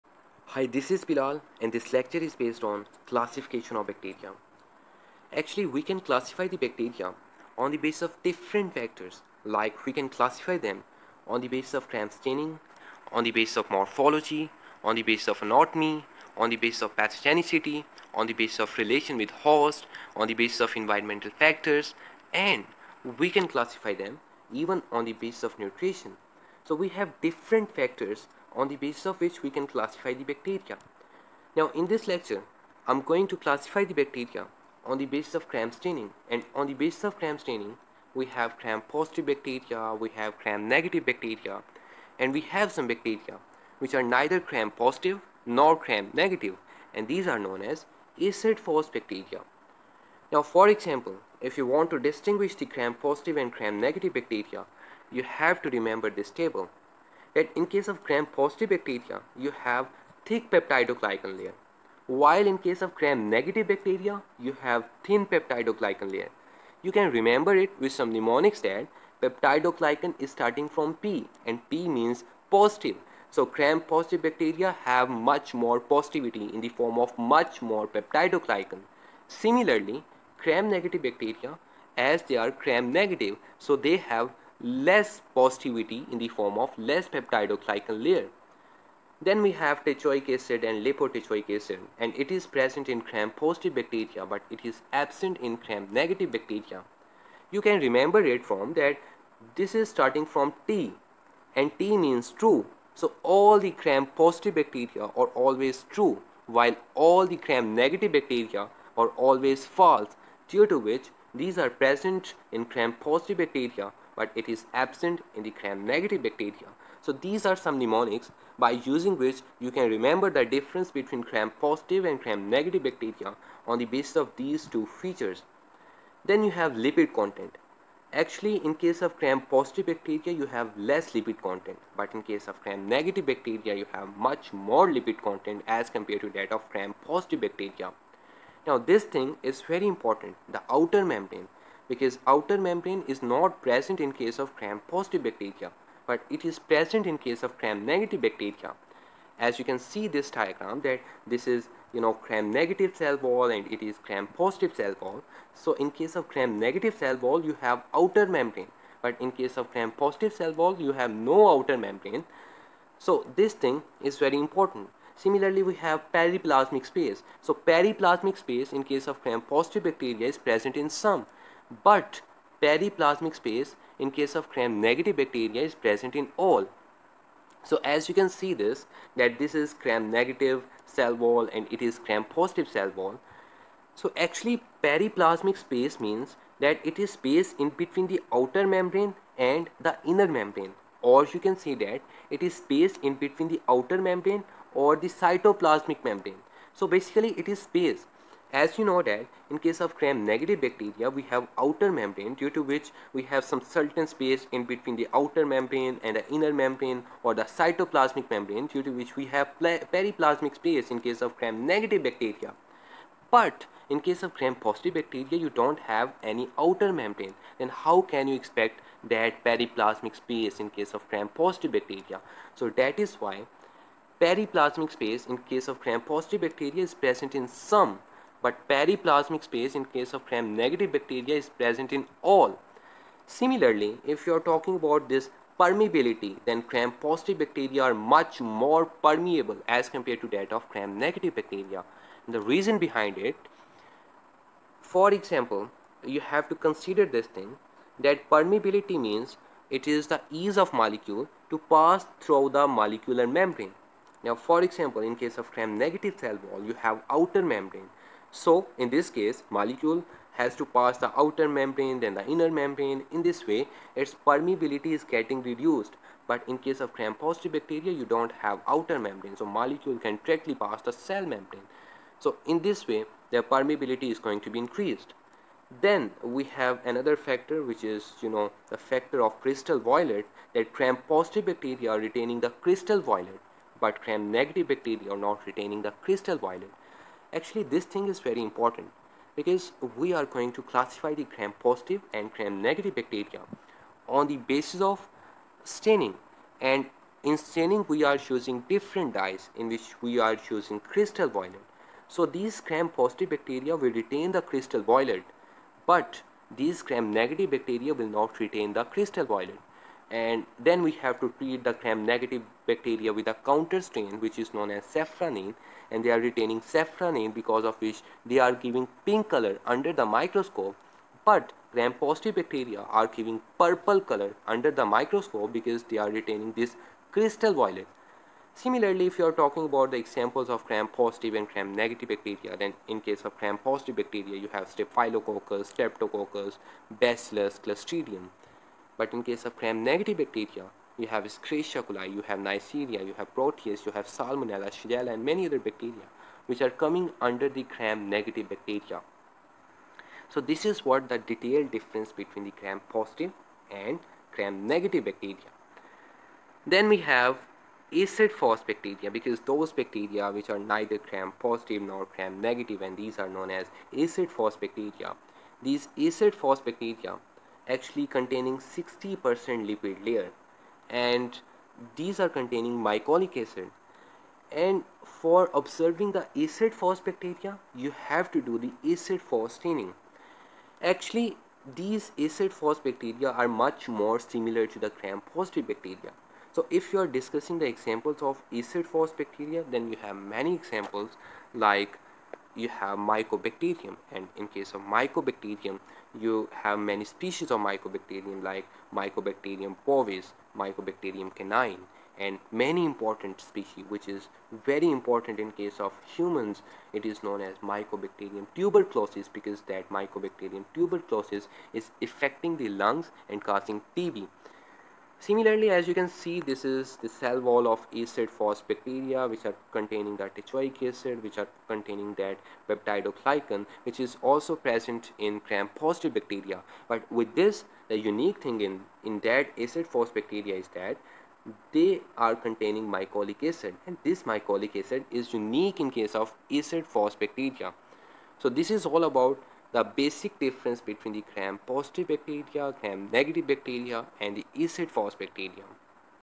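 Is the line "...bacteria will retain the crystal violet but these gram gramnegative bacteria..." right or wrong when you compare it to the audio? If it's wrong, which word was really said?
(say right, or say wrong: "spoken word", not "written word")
wrong: "negative", not "gramnegative".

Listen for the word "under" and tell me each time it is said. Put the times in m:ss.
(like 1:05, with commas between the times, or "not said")
5:19, 5:24, 5:47.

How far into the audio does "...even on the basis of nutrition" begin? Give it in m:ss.
0:24.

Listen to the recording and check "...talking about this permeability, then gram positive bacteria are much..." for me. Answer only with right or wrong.
right.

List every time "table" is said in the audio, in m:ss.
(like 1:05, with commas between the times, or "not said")
0:56.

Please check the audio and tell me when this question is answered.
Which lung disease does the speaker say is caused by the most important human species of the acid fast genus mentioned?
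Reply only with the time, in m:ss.
6:53.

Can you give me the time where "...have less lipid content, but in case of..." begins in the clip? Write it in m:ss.
2:10.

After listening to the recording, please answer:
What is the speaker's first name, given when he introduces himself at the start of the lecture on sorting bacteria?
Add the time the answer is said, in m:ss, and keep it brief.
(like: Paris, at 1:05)
Bilal, at 0:01.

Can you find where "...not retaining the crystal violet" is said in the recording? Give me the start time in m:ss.
4:45.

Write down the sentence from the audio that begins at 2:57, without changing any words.
So as you can see this that this is gram negative cell wall and it is gram positive cell wall.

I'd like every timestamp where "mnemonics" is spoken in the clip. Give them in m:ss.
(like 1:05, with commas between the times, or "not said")
1:08, 1:57.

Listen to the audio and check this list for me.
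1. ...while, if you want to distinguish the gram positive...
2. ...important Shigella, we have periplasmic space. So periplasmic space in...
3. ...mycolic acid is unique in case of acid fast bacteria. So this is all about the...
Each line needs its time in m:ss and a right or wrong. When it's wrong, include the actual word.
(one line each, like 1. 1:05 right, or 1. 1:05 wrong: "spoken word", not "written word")
1. 0:50 wrong: "example", not "while"
2. 2:44 wrong: "Similarly", not "Shigella"
3. 7:14 right.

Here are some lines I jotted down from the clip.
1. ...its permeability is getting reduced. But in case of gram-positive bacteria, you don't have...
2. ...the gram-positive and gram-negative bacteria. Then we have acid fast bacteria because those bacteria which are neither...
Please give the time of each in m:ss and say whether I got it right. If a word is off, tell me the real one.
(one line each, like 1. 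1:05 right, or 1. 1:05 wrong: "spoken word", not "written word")
1. 4:23 right
2. 5:52 right.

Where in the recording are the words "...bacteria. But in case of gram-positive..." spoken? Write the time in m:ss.
3:32.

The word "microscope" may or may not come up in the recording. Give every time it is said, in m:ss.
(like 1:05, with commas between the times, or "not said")
5:20, 5:24.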